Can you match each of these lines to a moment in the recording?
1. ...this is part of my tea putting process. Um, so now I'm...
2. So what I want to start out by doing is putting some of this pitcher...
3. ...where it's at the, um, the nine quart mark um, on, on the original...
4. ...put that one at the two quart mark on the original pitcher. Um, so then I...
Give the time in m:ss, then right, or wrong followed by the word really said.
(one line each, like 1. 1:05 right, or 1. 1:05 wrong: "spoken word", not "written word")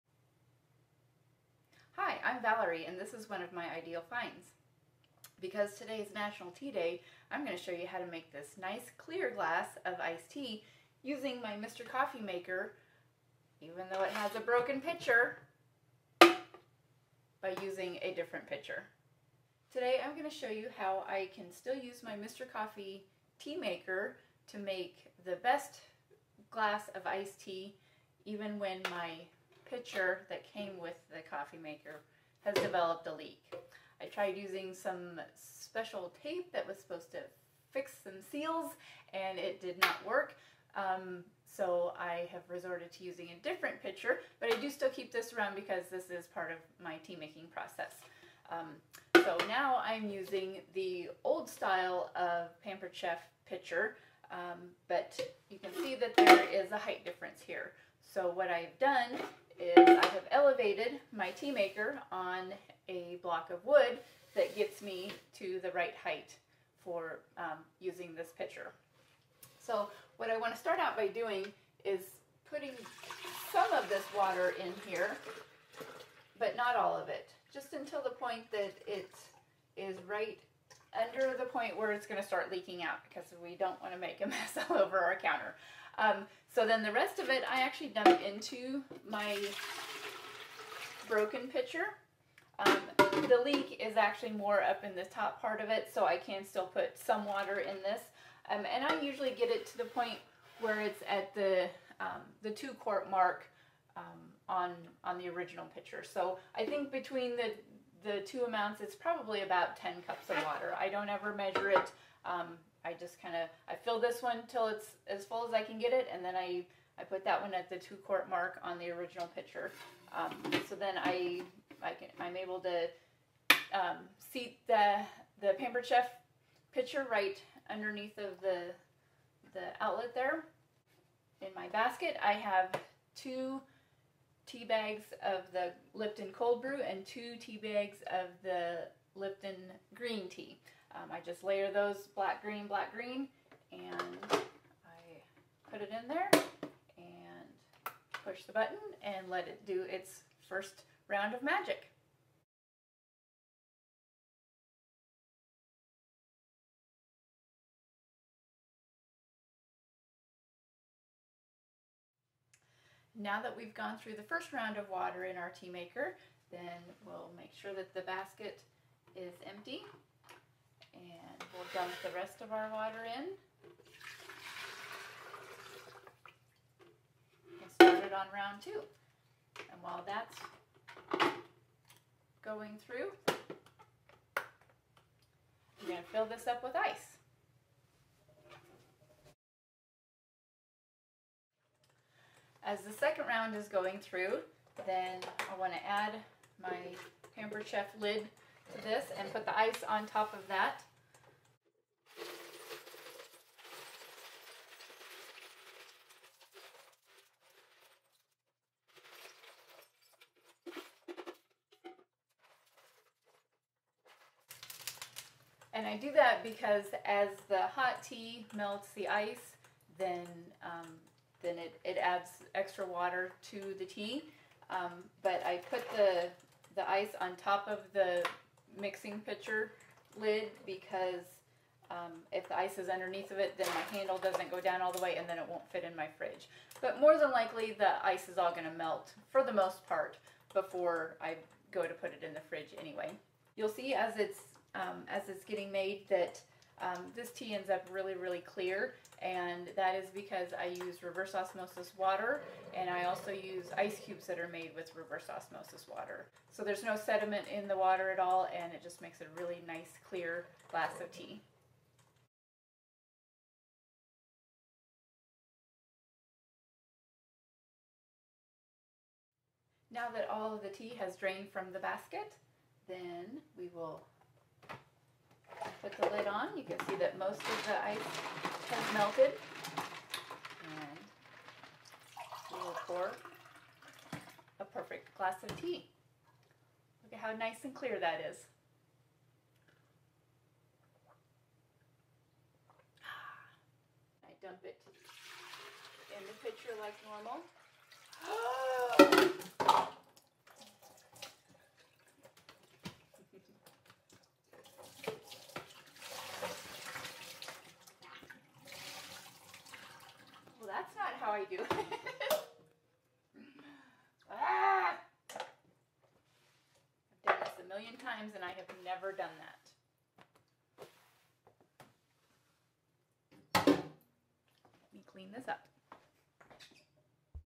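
1. 0:45 wrong: "making", not "putting"
2. 1:09 wrong: "water", not "pitcher"
3. 1:40 wrong: "two", not "nine"
4. 1:57 right.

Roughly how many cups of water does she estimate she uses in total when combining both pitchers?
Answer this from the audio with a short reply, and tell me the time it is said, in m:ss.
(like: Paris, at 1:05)
10 cups, at 1:49.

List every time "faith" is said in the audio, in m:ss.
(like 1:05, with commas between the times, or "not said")
not said.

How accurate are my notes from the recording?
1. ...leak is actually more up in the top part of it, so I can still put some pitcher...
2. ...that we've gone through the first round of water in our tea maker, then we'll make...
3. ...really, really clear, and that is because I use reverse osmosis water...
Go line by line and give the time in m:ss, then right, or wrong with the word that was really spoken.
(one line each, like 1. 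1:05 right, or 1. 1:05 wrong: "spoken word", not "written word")
1. 1:33 wrong: "water", not "pitcher"
2. 2:43 right
3. 4:07 right.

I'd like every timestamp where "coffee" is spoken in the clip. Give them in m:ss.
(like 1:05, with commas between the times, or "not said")
0:11, 0:22, 0:31.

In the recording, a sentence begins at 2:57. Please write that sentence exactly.
And start it on round two.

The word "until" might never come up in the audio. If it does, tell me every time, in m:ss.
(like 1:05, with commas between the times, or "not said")
1:17.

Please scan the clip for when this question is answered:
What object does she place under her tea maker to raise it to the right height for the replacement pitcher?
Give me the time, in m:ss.
1:02.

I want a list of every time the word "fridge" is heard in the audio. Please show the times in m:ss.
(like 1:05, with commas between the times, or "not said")
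3:56, 4:02.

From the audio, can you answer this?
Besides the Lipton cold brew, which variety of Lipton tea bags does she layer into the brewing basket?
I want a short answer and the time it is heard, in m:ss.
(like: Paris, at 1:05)
green tea, at 2:19.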